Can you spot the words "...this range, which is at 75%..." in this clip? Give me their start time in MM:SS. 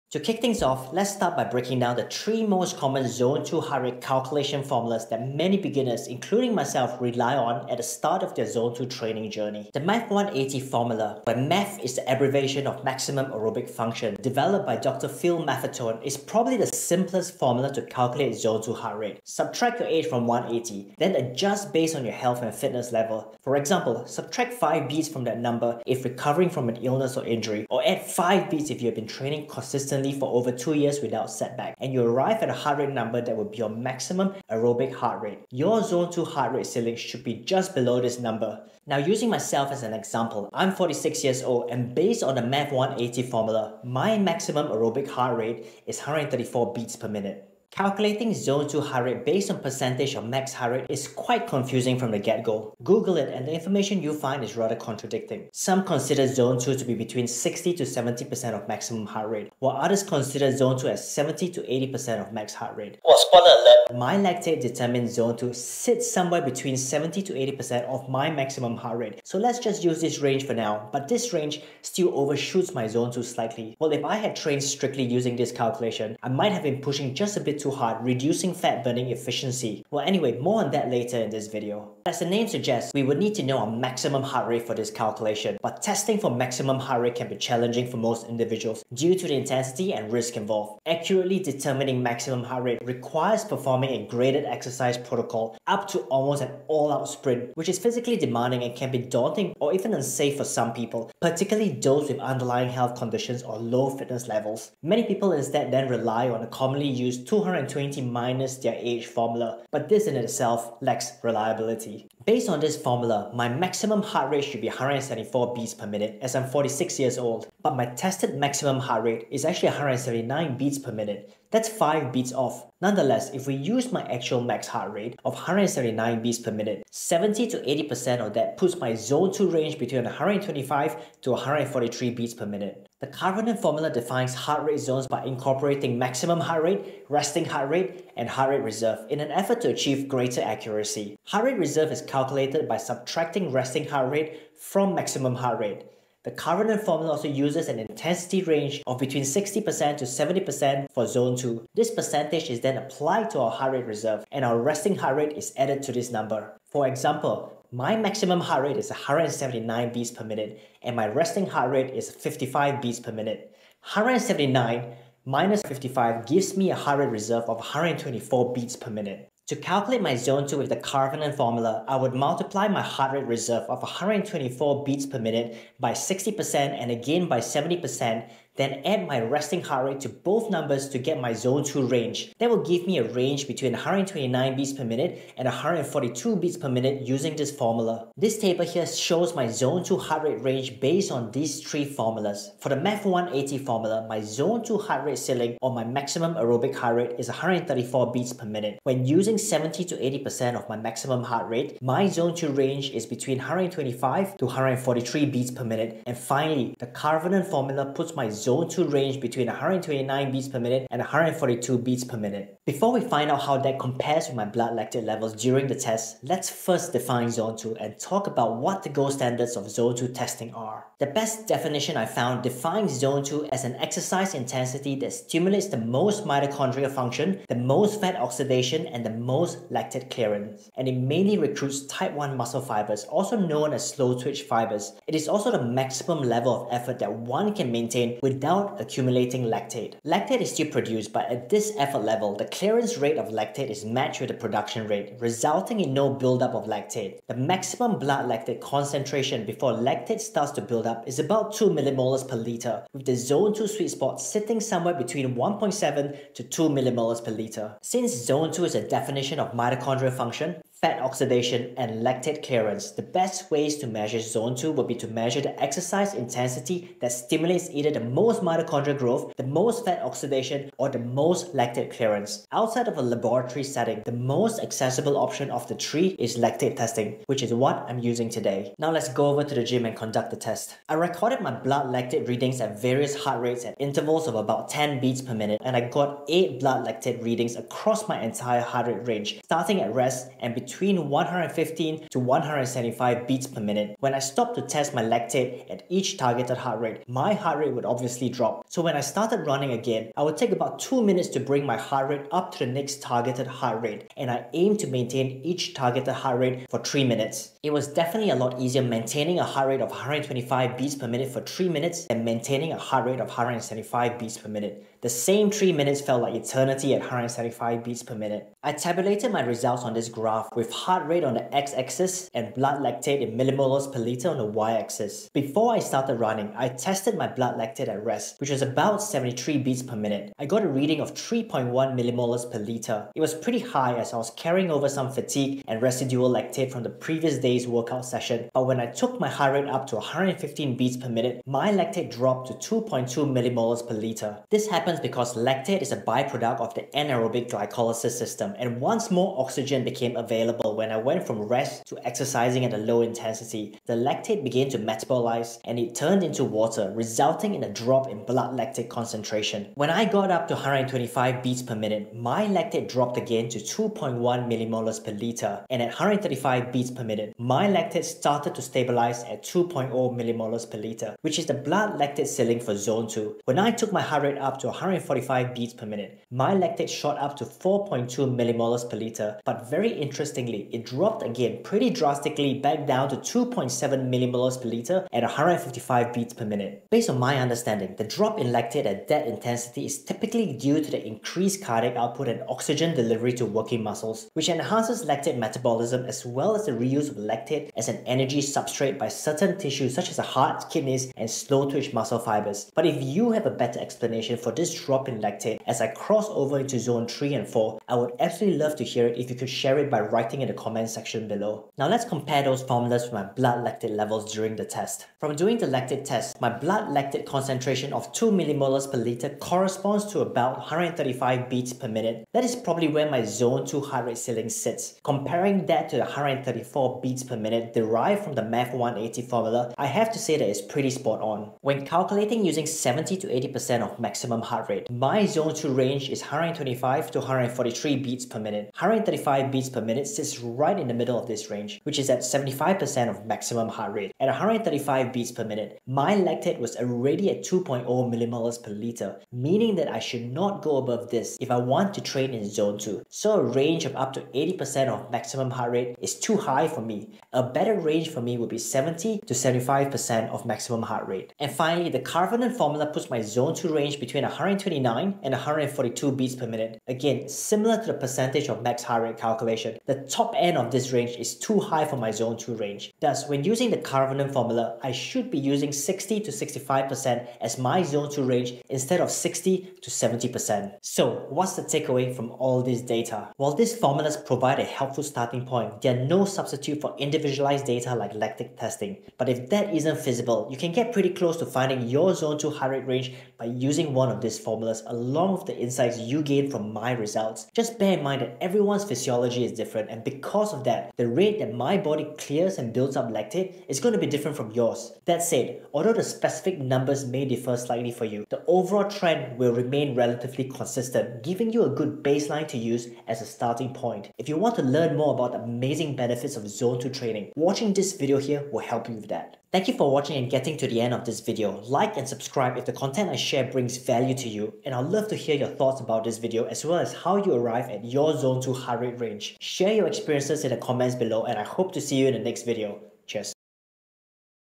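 07:21.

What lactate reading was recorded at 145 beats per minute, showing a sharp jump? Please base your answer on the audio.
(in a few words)
4.2.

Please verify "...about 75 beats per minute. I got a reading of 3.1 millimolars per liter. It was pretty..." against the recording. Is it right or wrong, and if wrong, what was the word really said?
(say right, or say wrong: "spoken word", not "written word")
wrong: "73", not "75".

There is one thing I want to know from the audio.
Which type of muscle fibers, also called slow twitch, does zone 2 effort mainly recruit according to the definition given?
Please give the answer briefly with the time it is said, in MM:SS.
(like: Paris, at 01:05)
Type 1, at 03:51.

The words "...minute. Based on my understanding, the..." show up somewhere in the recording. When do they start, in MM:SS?
06:26.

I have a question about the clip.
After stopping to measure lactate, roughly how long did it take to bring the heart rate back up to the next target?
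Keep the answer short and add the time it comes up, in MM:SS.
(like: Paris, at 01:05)
2 minutes, at 05:00.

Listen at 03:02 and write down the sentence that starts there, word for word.
That will give me a range between 129 beats per minute and 142 beats per minute using this formula.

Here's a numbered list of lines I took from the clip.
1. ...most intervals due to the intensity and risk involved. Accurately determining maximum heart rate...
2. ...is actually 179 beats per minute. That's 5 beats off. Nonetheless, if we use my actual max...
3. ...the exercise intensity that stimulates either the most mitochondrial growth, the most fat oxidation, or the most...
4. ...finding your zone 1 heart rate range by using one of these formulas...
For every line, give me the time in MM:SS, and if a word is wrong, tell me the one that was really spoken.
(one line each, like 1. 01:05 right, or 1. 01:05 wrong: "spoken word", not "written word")
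1. 01:27 wrong: "individuals", not "intervals"
2. 01:59 right
3. 04:25 right
4. 08:11 wrong: "2", not "1".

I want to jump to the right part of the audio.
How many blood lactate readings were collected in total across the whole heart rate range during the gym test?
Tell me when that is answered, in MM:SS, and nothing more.
04:46.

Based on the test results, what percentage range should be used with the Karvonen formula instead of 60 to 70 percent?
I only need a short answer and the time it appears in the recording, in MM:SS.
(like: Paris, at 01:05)
60 to 65%, at 07:55.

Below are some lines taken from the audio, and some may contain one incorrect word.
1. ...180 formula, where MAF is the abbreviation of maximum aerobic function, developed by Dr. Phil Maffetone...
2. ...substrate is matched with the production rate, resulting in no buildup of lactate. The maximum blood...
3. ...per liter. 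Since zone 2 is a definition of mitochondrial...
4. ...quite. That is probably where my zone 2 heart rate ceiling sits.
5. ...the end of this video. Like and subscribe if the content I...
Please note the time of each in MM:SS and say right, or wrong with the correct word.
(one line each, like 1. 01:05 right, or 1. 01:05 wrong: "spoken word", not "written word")
1. 00:10 right
2. 04:03 wrong: "lactate", not "substrate"
3. 04:17 right
4. 07:01 wrong: "minute", not "quite"
5. 08:40 right.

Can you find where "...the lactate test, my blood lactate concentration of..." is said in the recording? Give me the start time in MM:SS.
06:55.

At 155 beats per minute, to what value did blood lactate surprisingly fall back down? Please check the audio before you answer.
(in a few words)
2.7.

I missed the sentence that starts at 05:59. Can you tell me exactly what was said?
When I got up to 125 beats per minute, my lactate dropped again to 2.1 millimolars per liter.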